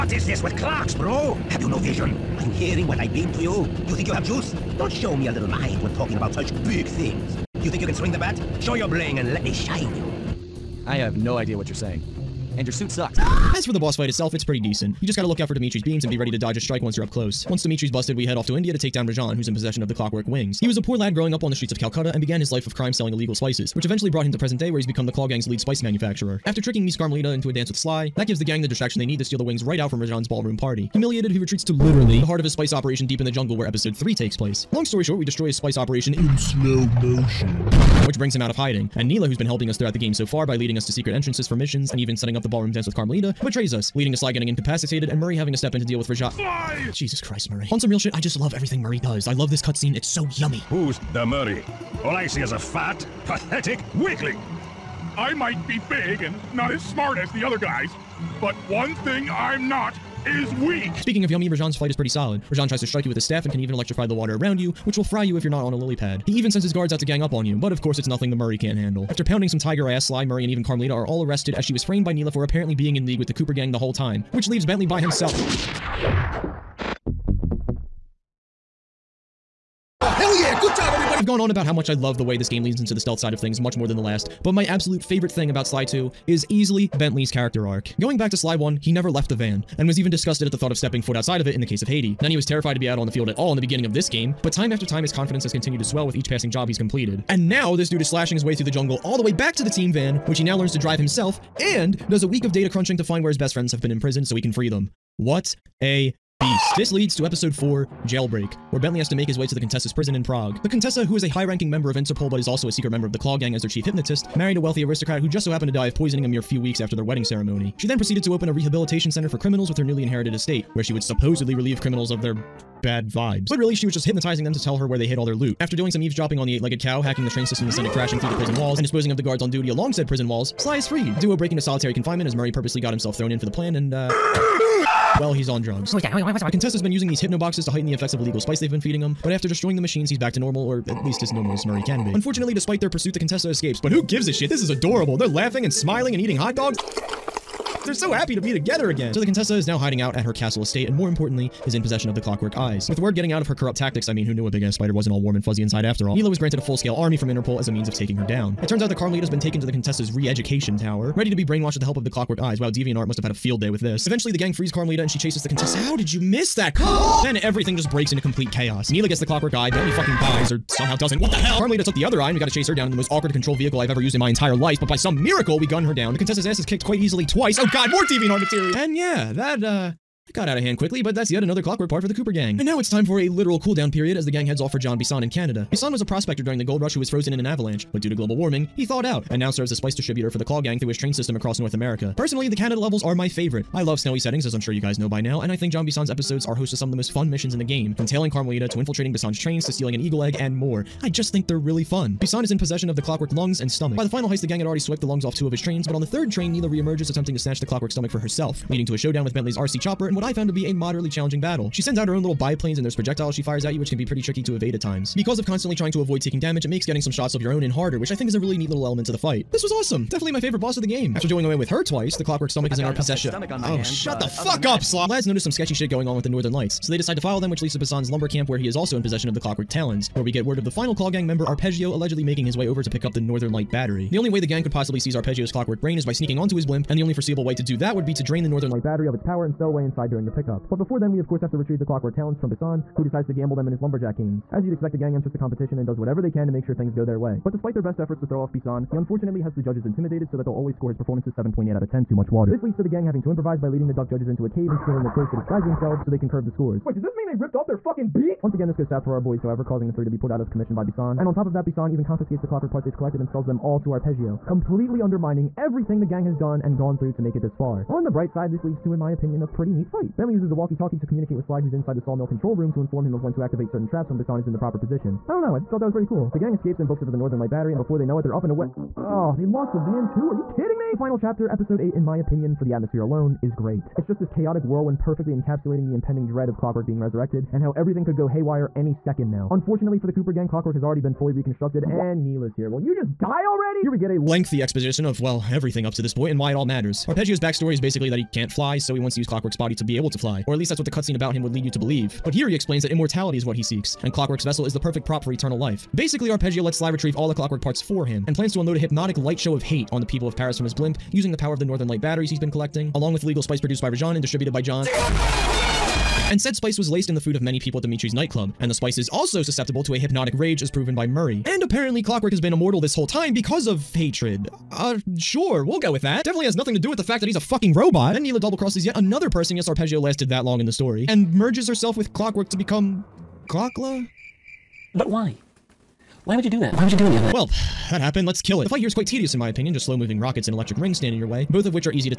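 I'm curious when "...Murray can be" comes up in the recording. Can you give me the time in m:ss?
2:21.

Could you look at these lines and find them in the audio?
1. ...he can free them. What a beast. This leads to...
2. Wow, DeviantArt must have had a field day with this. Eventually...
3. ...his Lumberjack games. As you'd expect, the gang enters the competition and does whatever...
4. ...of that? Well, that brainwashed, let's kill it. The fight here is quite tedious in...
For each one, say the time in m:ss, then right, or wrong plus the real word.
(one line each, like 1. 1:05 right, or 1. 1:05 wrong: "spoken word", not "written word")
1. 1:44 right
2. 2:42 right
3. 4:03 right
4. 5:37 wrong: "happened", not "brainwashed".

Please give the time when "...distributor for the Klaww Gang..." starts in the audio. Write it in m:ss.
3:09.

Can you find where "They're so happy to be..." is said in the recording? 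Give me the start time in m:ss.
2:27.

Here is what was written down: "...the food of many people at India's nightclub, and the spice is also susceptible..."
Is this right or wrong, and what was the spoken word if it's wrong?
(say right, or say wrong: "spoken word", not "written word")
wrong: "Dimitri", not "India".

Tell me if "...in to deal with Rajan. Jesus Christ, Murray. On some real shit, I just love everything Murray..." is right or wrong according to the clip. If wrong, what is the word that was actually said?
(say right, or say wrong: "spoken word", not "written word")
right.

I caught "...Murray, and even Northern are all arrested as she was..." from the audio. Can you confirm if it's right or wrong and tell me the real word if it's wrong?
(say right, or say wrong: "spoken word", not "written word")
wrong: "Carmelita", not "Northern".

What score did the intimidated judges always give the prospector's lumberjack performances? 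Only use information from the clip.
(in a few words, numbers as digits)
7.8 out of 10.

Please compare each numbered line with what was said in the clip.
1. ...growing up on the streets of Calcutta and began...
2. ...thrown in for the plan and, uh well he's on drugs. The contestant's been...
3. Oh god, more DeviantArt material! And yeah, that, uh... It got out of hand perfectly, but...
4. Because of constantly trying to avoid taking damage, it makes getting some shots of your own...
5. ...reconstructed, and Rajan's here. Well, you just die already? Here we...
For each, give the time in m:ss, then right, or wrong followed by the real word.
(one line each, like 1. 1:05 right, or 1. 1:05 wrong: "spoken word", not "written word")
1. 0:21 right
2. 2:13 right
3. 2:57 wrong: "quickly", not "perfectly"
4. 3:35 right
5. 4:51 wrong: "Neyla", not "Rajan".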